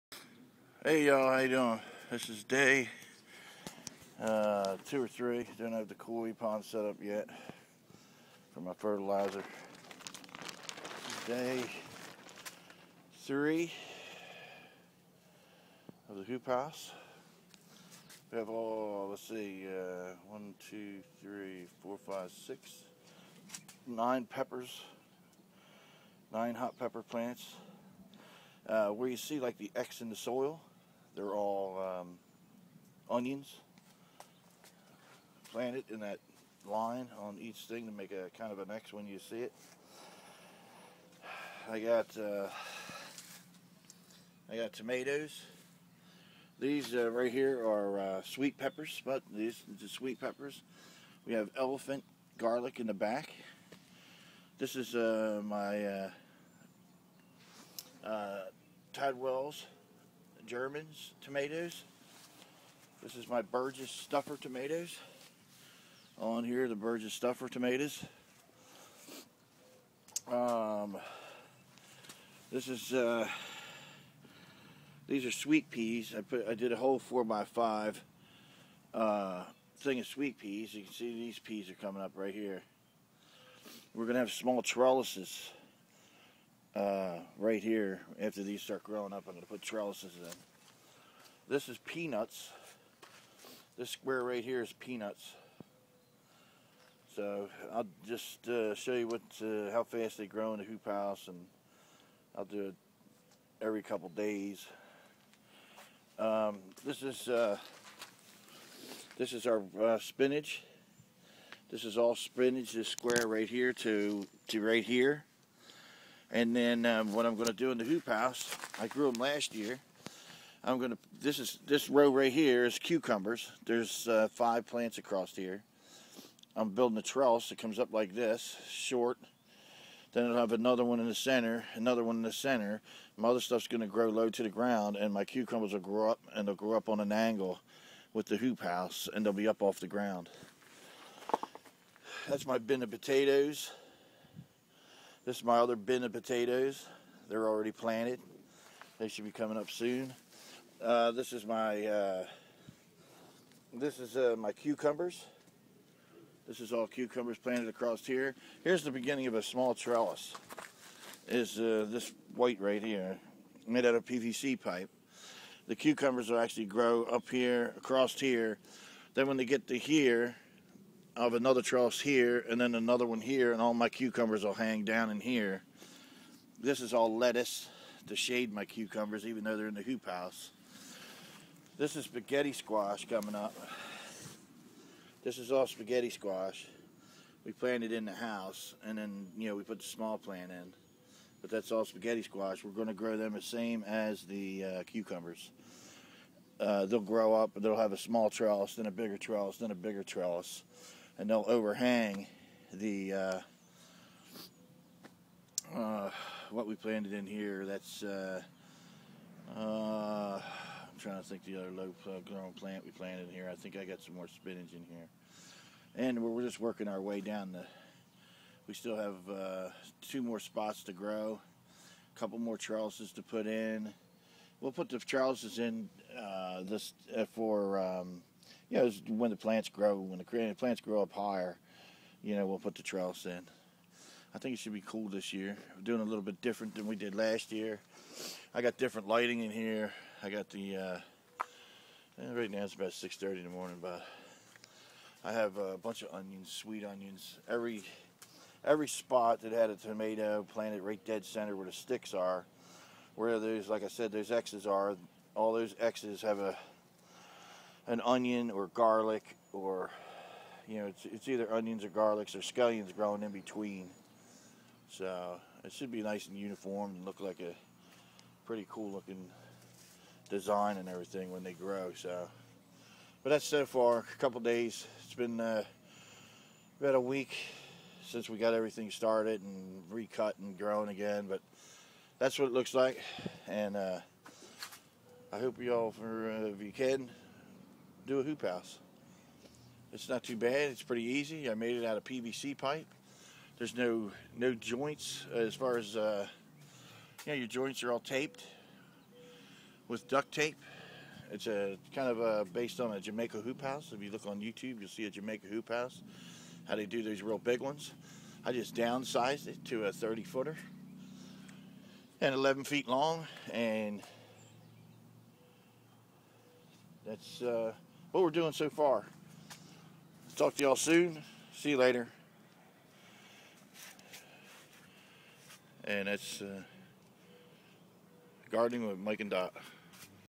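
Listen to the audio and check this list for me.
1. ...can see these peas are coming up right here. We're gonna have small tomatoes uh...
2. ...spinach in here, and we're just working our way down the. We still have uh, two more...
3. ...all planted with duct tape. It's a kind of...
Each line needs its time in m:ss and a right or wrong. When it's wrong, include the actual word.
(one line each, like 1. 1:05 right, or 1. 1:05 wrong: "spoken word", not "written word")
1. 1:20 wrong: "trellises", not "tomatoes"
2. 3:34 right
3. 4:57 wrong: "taped", not "planted".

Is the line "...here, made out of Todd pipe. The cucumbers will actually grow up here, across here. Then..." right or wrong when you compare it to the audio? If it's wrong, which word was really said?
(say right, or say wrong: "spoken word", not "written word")
wrong: "PVC", not "Todd".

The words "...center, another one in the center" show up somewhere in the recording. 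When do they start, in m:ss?
2:11.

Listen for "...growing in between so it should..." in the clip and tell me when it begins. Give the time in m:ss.
4:22.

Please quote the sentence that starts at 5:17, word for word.
Uh, what we're doing so far.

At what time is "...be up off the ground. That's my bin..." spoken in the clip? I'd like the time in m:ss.
2:19.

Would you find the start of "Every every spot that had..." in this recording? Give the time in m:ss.
4:07.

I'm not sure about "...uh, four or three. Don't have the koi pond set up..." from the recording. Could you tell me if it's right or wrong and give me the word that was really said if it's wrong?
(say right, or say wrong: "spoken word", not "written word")
wrong: "two", not "four".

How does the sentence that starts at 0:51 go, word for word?
We have elephant garlic in the back.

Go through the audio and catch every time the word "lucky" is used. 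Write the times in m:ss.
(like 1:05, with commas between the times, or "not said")
not said.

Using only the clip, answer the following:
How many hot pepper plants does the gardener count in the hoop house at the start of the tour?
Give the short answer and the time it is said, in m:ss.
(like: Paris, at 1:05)
9, at 0:26.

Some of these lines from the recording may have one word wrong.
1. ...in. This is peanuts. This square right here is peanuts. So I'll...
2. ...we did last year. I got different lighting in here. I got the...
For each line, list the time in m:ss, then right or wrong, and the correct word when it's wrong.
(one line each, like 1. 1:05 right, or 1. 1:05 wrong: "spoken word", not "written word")
1. 1:30 right
2. 3:56 right.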